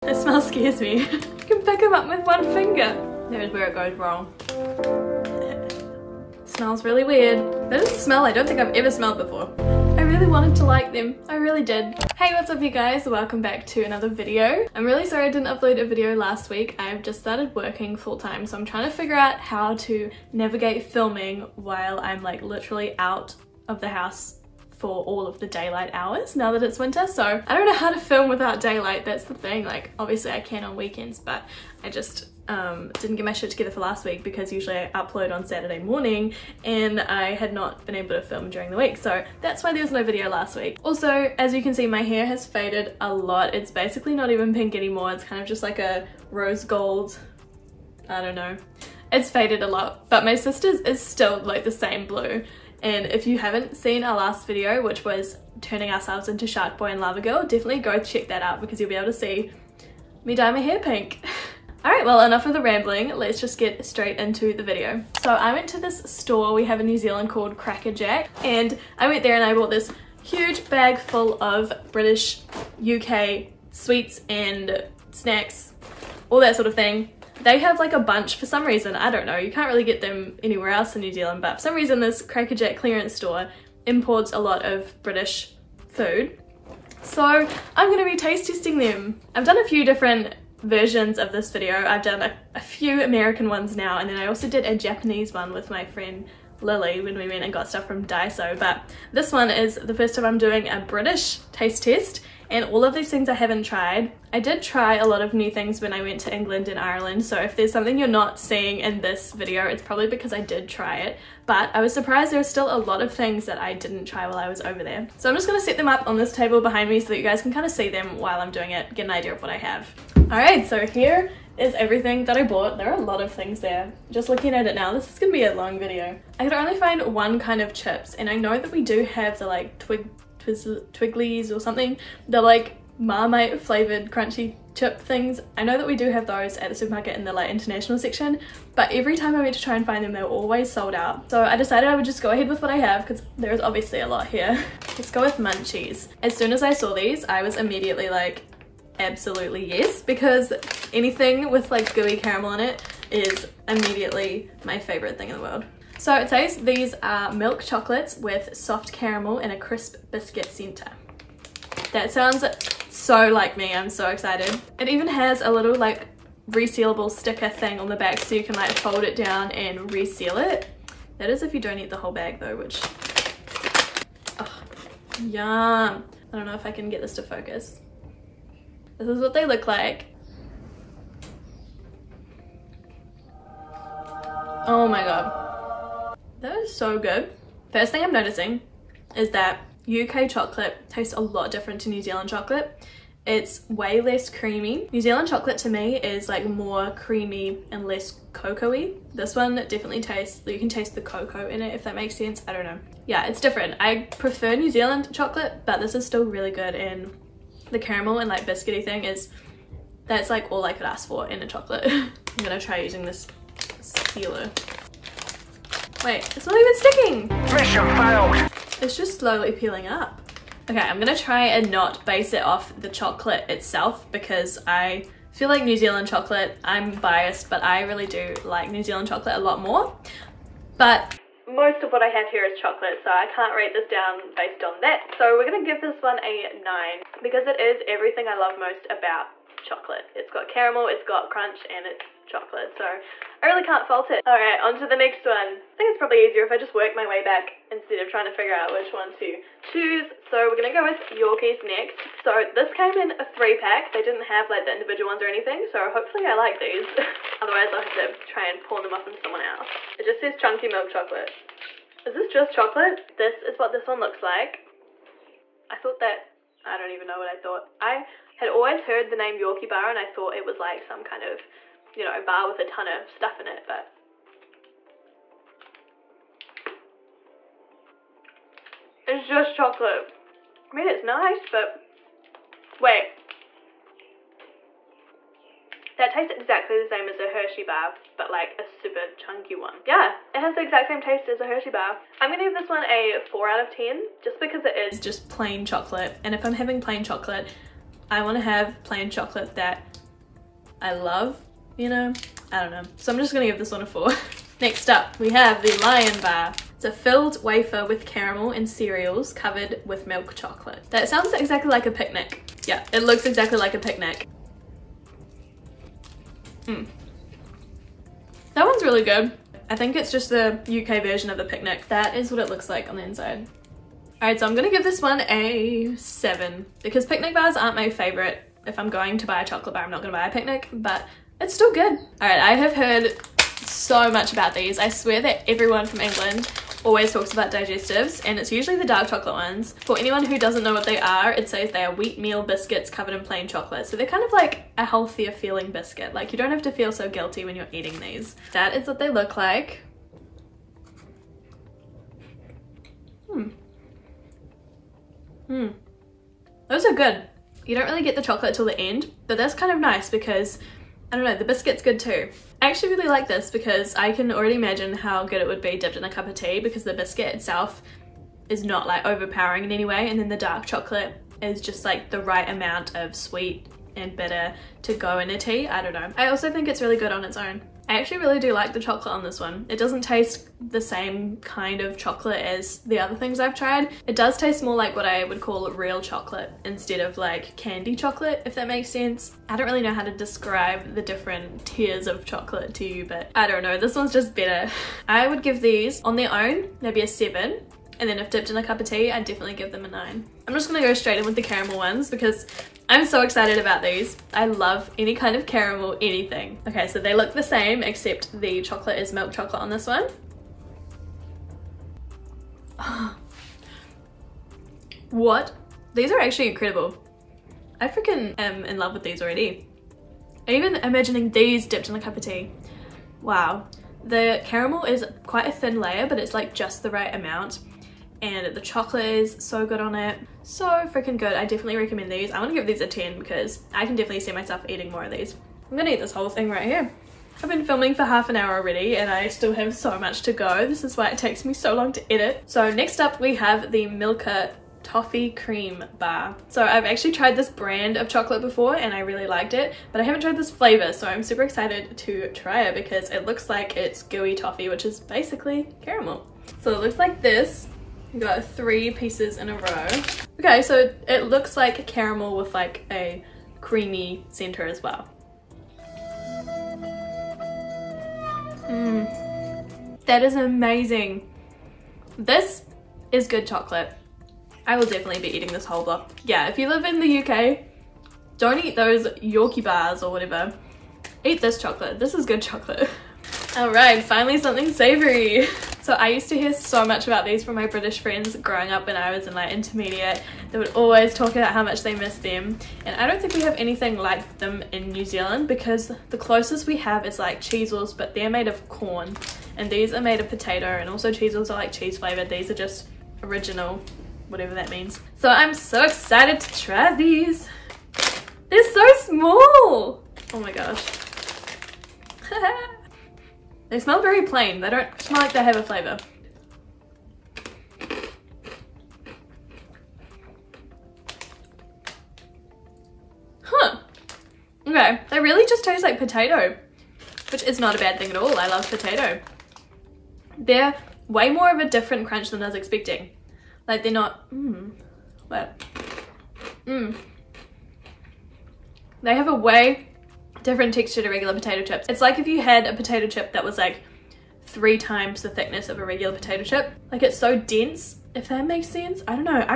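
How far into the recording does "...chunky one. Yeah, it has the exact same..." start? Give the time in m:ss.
4:49.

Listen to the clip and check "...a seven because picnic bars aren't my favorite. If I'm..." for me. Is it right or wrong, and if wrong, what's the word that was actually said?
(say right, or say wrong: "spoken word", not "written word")
right.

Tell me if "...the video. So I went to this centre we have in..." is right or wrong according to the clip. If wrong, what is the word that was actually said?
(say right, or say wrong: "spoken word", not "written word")
wrong: "store", not "centre".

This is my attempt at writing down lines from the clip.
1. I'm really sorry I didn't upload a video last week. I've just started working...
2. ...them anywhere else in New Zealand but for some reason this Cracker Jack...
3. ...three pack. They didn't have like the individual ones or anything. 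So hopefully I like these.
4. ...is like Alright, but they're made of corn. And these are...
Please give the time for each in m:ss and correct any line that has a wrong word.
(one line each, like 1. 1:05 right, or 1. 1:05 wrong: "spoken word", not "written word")
1. 0:14 right
2. 1:20 right
3. 4:13 right
4. 8:17 wrong: "Cheezels", not "Alright".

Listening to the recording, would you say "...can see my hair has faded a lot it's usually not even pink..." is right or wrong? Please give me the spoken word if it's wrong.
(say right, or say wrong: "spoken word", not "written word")
wrong: "basically", not "usually".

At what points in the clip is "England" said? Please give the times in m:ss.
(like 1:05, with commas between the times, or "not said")
1:46, 5:35.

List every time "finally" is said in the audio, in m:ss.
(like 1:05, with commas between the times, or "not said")
8:04.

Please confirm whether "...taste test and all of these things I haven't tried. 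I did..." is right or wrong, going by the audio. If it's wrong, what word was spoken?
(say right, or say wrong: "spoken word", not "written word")
right.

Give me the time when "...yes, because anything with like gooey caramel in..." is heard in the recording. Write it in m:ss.
2:29.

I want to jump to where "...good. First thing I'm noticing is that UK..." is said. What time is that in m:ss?
3:06.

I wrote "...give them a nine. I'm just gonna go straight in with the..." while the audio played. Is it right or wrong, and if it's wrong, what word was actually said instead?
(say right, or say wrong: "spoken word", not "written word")
right.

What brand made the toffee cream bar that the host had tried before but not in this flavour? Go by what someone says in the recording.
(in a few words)
Milka.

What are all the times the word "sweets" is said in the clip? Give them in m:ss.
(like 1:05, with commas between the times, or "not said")
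1:13, 6:13.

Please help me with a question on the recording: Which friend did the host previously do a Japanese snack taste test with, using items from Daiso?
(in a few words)
Lily.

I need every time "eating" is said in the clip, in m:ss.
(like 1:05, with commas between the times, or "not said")
5:47, 7:14, 7:55.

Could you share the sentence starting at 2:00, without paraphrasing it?
Alright so here is everything that I bought.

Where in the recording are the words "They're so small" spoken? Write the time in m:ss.
8:28.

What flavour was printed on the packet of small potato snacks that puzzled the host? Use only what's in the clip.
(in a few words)
Original.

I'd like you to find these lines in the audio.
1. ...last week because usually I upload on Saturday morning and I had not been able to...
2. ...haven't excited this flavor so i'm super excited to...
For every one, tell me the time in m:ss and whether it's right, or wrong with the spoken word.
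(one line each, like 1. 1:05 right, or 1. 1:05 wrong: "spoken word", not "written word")
1. 0:33 right
2. 7:30 wrong: "tried", not "excited".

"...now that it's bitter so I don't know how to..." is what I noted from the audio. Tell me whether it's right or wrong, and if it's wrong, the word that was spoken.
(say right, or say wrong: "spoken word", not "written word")
wrong: "winter", not "bitter".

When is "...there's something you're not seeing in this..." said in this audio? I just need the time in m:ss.
1:47.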